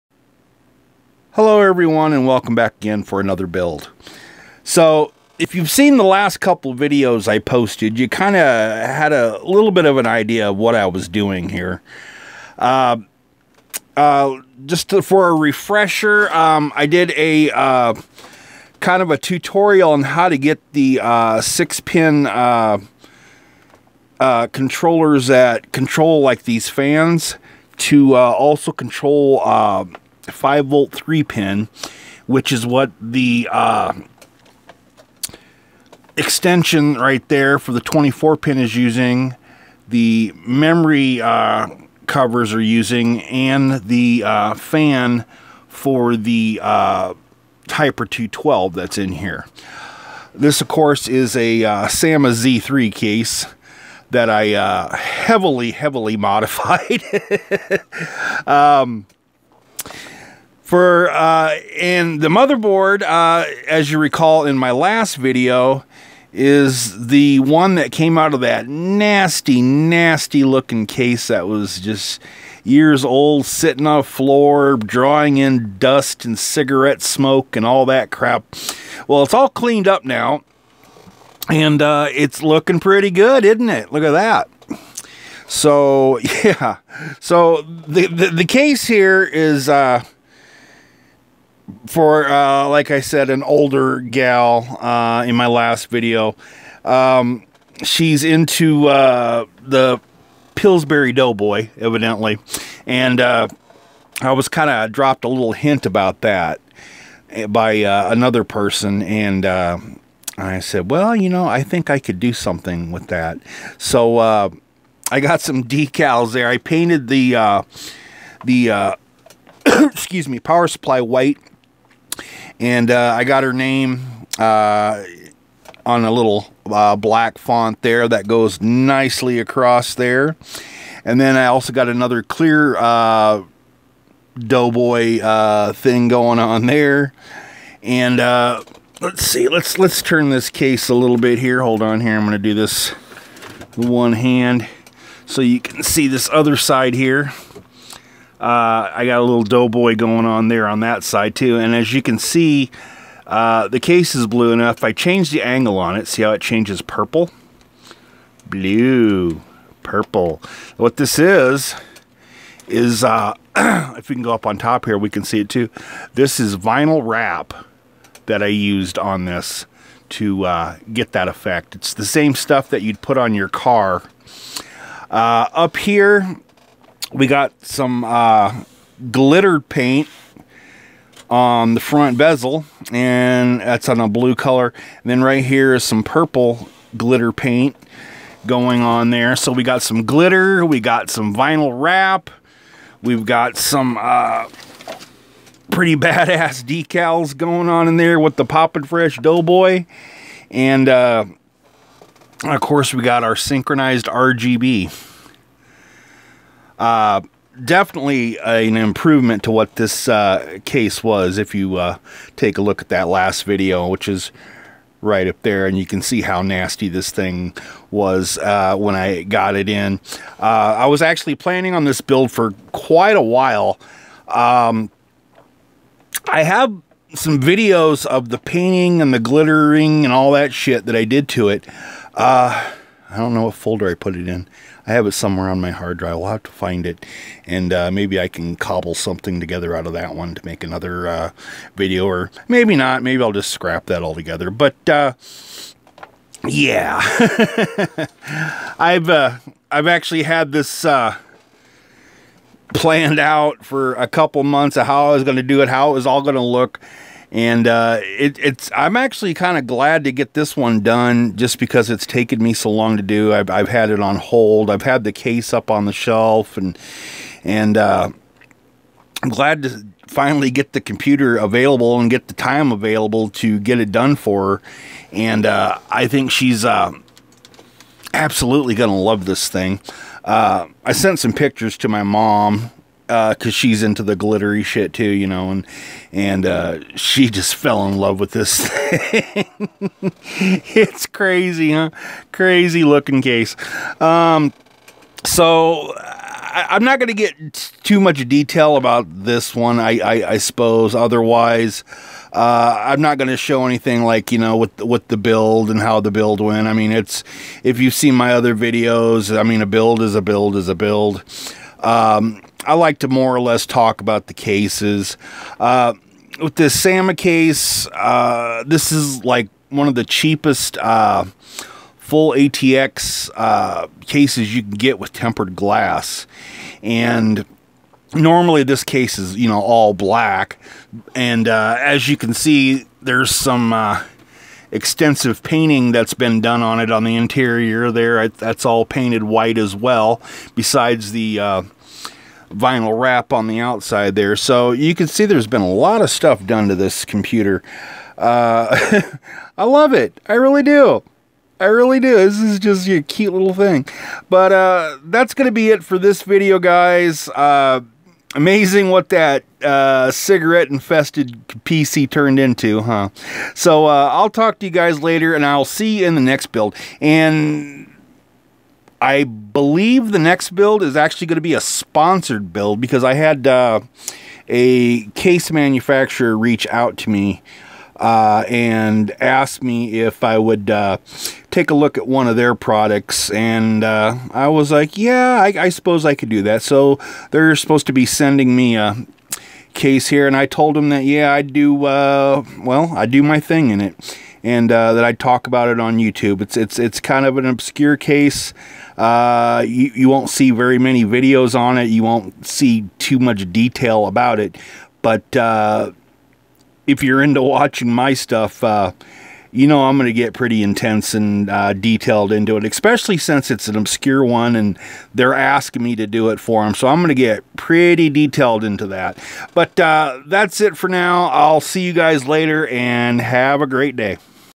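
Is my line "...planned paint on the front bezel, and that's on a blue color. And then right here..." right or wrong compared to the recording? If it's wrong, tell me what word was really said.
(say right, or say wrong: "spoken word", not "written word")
wrong: "glittered", not "planned".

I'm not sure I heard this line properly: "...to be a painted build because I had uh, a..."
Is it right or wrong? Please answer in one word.
wrong.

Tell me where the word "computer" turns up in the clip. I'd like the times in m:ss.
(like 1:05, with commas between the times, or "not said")
4:30, 5:47.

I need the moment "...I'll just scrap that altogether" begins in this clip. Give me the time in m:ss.
4:03.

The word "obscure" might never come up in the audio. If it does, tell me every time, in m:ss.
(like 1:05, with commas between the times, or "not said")
6:37, 6:53.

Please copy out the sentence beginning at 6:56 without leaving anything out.
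So I'm going to get pretty detailed into that.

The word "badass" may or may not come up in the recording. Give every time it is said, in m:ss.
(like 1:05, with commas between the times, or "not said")
3:15.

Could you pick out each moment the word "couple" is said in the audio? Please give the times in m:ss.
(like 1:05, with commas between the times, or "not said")
0:06, 4:14.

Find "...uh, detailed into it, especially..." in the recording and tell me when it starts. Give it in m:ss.
6:51.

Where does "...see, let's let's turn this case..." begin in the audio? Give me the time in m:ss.
2:19.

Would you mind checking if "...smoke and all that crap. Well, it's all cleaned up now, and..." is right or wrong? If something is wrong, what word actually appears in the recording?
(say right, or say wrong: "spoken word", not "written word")
right.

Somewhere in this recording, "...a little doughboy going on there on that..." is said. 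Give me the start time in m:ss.
2:29.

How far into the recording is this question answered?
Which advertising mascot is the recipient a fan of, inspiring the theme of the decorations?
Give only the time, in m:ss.
1:40.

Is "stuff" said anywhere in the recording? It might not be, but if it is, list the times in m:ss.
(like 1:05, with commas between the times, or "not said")
2:52, 5:46, 6:48.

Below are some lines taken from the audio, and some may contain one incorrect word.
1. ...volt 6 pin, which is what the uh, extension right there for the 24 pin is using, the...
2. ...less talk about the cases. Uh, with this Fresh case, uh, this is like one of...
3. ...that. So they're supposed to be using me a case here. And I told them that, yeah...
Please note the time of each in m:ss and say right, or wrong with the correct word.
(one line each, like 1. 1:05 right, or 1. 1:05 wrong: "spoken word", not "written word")
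1. 0:30 wrong: "3", not "6"
2. 5:13 wrong: "SAMA", not "Fresh"
3. 6:26 wrong: "sending", not "using".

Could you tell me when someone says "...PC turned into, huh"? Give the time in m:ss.
6:01.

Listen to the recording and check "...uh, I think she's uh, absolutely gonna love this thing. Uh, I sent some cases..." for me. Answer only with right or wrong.
wrong.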